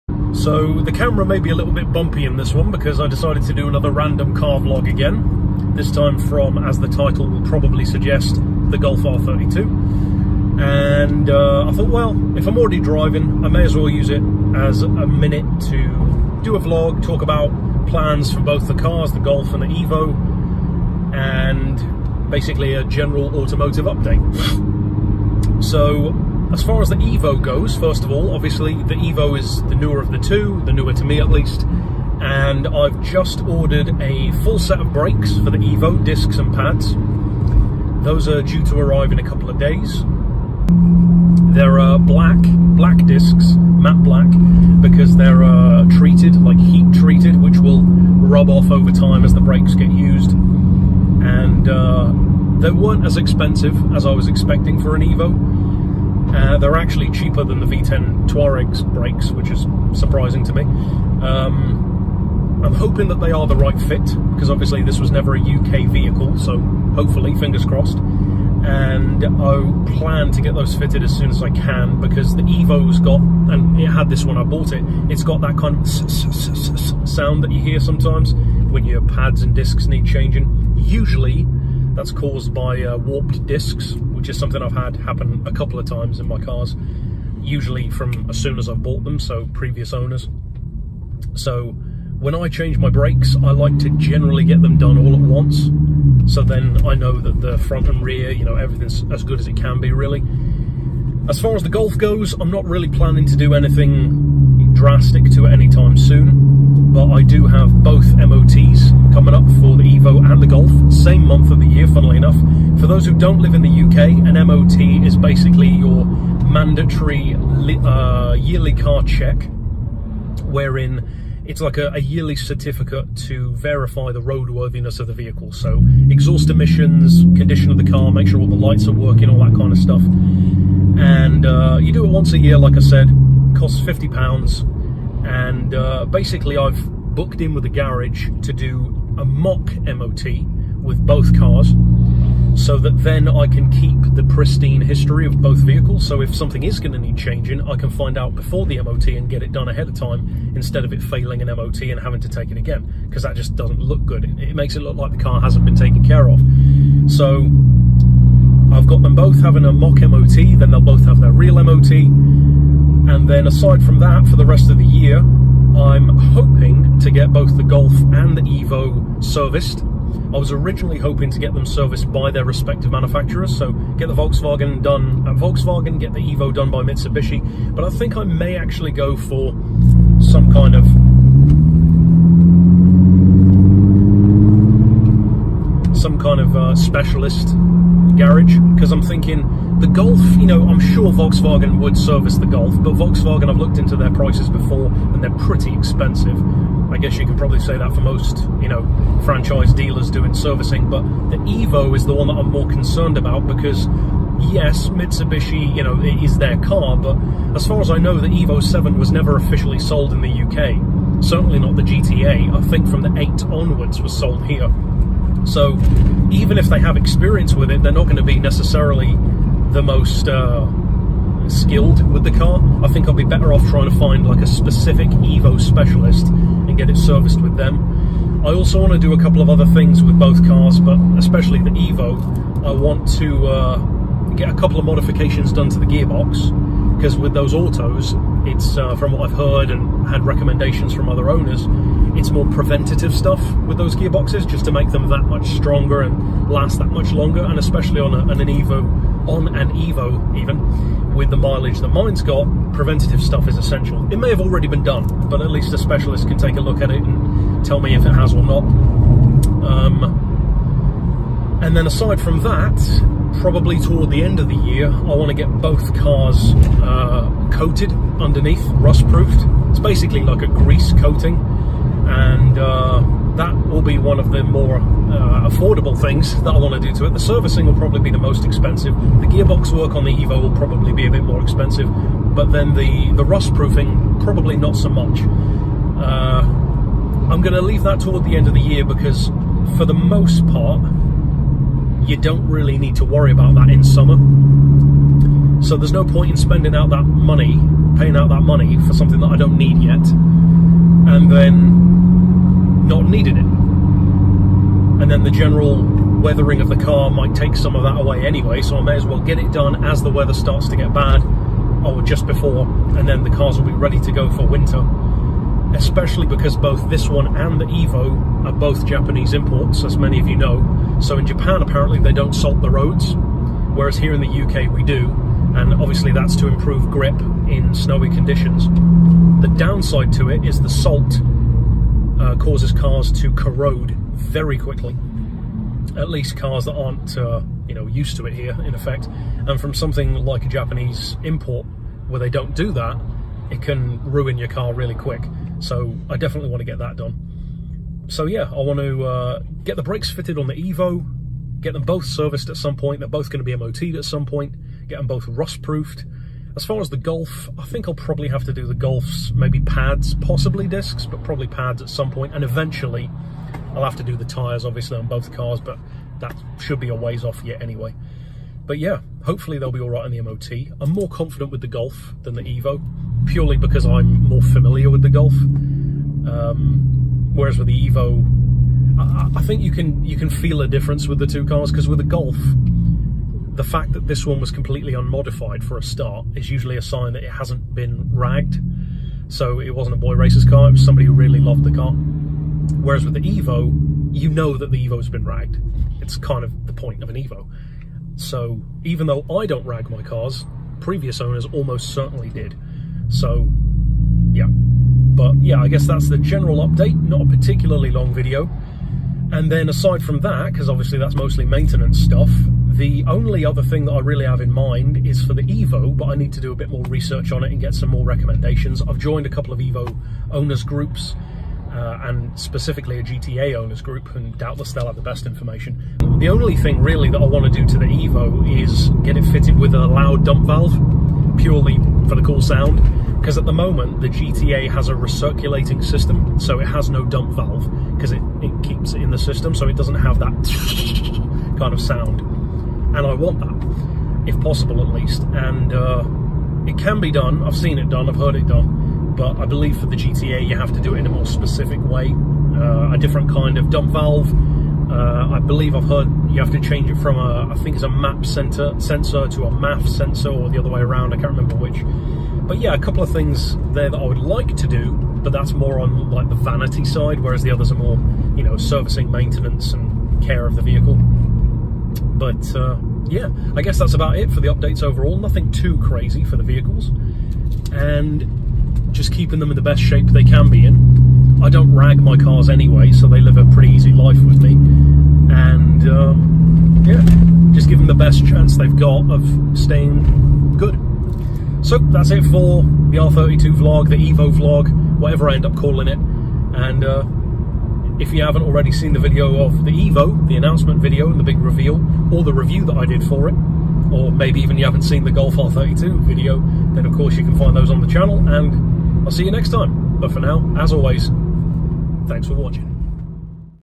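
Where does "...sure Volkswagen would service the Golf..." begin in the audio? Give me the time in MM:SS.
03:10.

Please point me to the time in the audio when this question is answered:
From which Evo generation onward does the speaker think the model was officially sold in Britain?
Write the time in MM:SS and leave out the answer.
03:33.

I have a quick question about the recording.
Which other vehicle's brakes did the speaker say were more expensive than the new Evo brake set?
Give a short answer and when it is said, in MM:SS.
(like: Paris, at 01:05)
V10 Touareg, at 00:57.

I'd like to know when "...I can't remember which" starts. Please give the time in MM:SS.
07:41.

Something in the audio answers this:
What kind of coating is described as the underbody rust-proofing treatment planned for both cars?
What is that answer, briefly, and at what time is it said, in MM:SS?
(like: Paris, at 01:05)
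Grease coating, at 04:30.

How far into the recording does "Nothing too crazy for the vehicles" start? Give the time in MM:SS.
07:55.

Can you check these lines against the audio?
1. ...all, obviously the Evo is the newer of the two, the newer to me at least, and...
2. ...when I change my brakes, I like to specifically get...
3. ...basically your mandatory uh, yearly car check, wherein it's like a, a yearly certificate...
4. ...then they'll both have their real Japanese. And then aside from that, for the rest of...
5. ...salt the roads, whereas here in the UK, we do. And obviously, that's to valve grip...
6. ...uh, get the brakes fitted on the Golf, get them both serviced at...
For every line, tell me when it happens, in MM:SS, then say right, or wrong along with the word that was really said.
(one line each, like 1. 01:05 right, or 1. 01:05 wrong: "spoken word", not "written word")
1. 00:28 right
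2. 01:32 wrong: "generally", not "specifically"
3. 01:55 right
4. 02:40 wrong: "MOT", not "Japanese"
5. 05:22 wrong: "improve", not "valve"
6. 05:49 wrong: "Evo", not "Golf".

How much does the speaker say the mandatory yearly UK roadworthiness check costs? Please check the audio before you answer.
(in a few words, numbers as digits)
£50.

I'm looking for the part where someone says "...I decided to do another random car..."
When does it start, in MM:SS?
00:02.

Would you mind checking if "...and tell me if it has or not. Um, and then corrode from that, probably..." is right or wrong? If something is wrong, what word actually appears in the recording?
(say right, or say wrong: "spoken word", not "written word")
wrong: "aside", not "corrode".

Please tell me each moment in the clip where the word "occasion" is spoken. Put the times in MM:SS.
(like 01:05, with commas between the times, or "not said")
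not said.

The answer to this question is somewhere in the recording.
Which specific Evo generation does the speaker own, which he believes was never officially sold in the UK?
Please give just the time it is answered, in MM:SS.
03:28.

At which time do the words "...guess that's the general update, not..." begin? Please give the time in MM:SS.
06:45.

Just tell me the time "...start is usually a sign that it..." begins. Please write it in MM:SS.
06:25.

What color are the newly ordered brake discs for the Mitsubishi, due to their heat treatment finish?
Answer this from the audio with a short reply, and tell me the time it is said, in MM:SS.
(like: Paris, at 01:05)
Matte black, at 00:43.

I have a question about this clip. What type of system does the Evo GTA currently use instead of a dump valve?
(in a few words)
Recirculating system.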